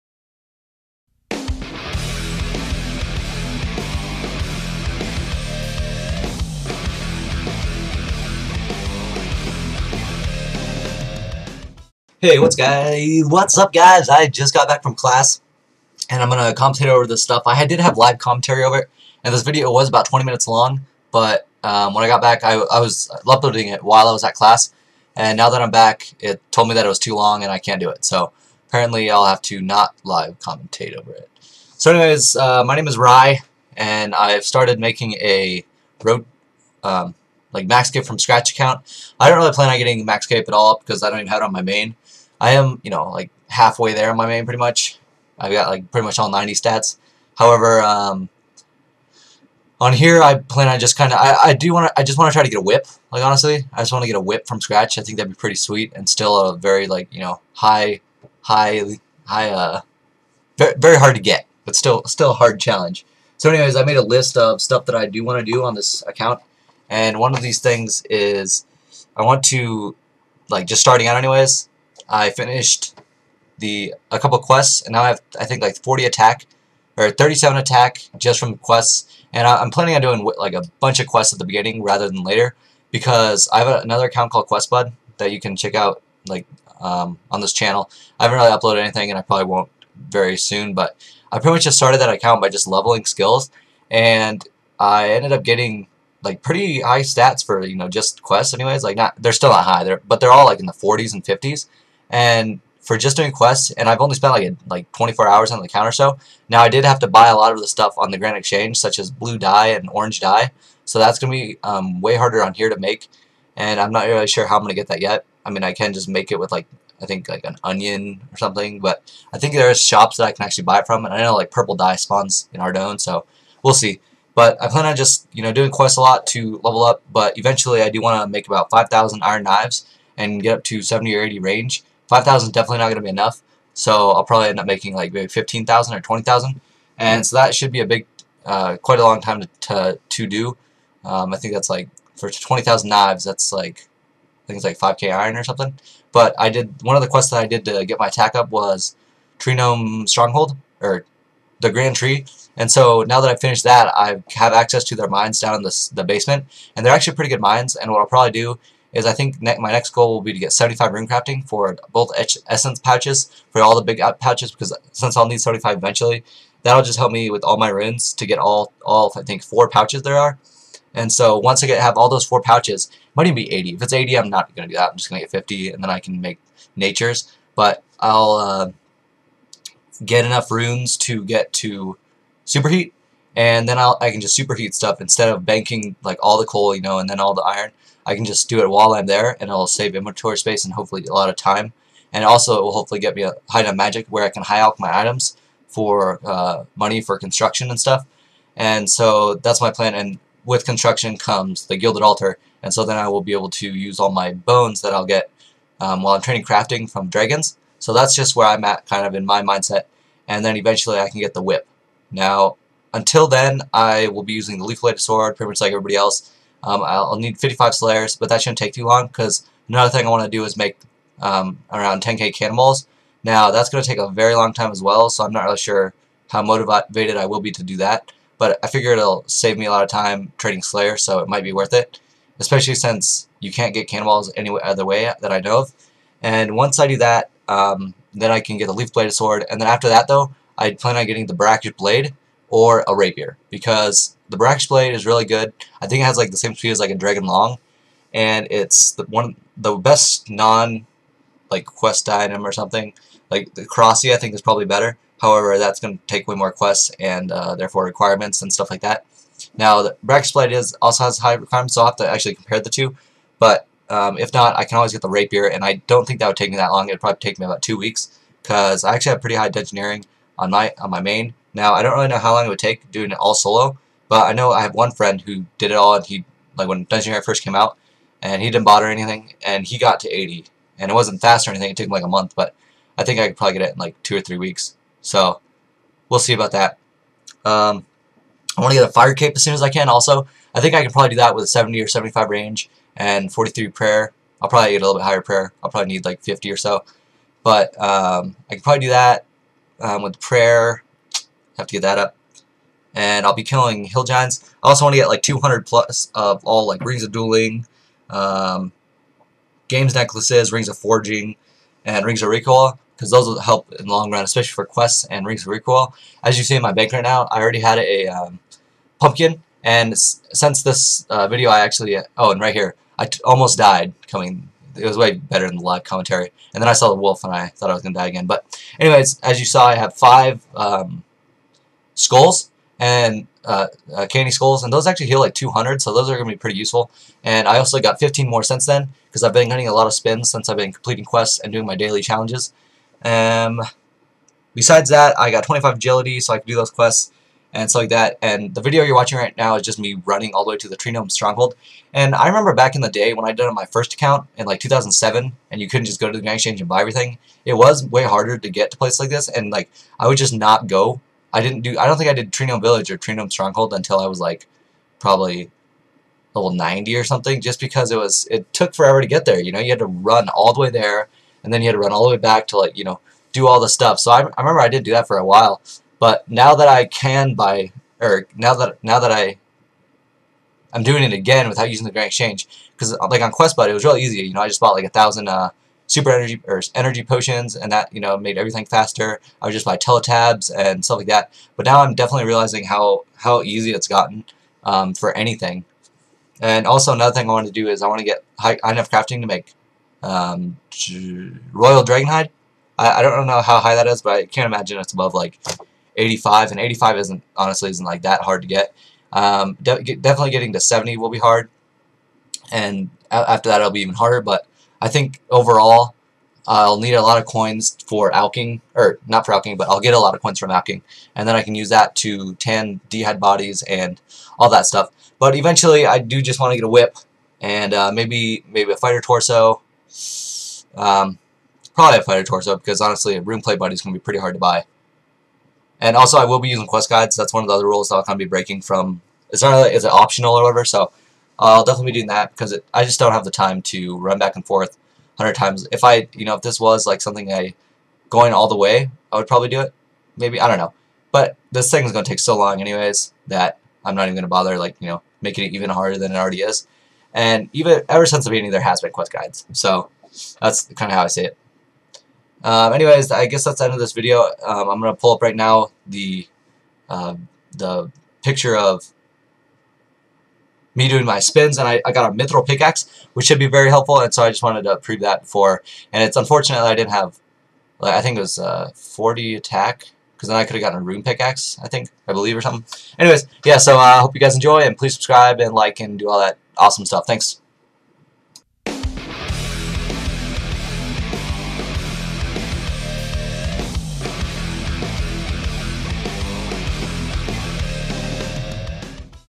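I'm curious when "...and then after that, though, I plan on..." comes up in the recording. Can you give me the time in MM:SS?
03:59.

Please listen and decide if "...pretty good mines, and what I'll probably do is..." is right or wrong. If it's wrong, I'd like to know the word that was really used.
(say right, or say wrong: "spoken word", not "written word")
right.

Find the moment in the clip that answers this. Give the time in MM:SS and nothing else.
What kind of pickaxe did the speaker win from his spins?
07:52.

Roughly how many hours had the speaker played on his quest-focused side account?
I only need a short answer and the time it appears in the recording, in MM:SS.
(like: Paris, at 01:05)
24, at 01:44.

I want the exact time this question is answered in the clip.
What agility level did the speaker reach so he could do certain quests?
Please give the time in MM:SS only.
05:45.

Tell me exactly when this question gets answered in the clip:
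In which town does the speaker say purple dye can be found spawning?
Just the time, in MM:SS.
02:02.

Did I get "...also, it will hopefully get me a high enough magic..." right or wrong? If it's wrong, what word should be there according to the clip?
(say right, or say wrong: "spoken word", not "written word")
right.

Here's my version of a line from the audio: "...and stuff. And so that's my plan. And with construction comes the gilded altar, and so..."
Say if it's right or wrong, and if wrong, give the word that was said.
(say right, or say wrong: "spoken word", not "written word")
right.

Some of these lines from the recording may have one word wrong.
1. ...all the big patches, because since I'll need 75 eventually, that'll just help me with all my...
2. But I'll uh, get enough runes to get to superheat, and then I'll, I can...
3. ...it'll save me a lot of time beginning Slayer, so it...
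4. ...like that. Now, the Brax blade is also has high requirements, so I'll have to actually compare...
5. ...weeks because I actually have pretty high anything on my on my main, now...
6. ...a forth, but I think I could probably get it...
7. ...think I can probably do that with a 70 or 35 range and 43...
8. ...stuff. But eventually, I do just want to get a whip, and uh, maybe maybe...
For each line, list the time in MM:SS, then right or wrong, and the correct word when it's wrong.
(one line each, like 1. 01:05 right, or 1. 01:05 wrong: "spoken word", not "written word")
1. 02:43 right
2. 02:57 right
3. 03:48 wrong: "trading", not "beginning"
4. 04:18 right
5. 04:27 wrong: "engineering", not "anything"
6. 04:42 wrong: "month", not "forth"
7. 04:50 wrong: "75", not "35"
8. 07:04 right.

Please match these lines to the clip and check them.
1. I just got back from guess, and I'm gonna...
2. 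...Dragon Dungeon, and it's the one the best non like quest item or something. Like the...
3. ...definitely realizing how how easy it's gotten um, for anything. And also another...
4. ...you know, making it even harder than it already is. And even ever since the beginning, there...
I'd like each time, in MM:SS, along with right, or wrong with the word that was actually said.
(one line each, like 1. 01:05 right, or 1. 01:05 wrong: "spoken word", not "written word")
1. 00:14 wrong: "class", not "guess"
2. 04:06 wrong: "Long", not "Dungeon"
3. 06:31 right
4. 07:34 right.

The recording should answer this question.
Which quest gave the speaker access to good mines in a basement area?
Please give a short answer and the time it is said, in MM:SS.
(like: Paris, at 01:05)
The Grand Tree, at 02:31.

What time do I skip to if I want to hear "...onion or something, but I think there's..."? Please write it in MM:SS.
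01:57.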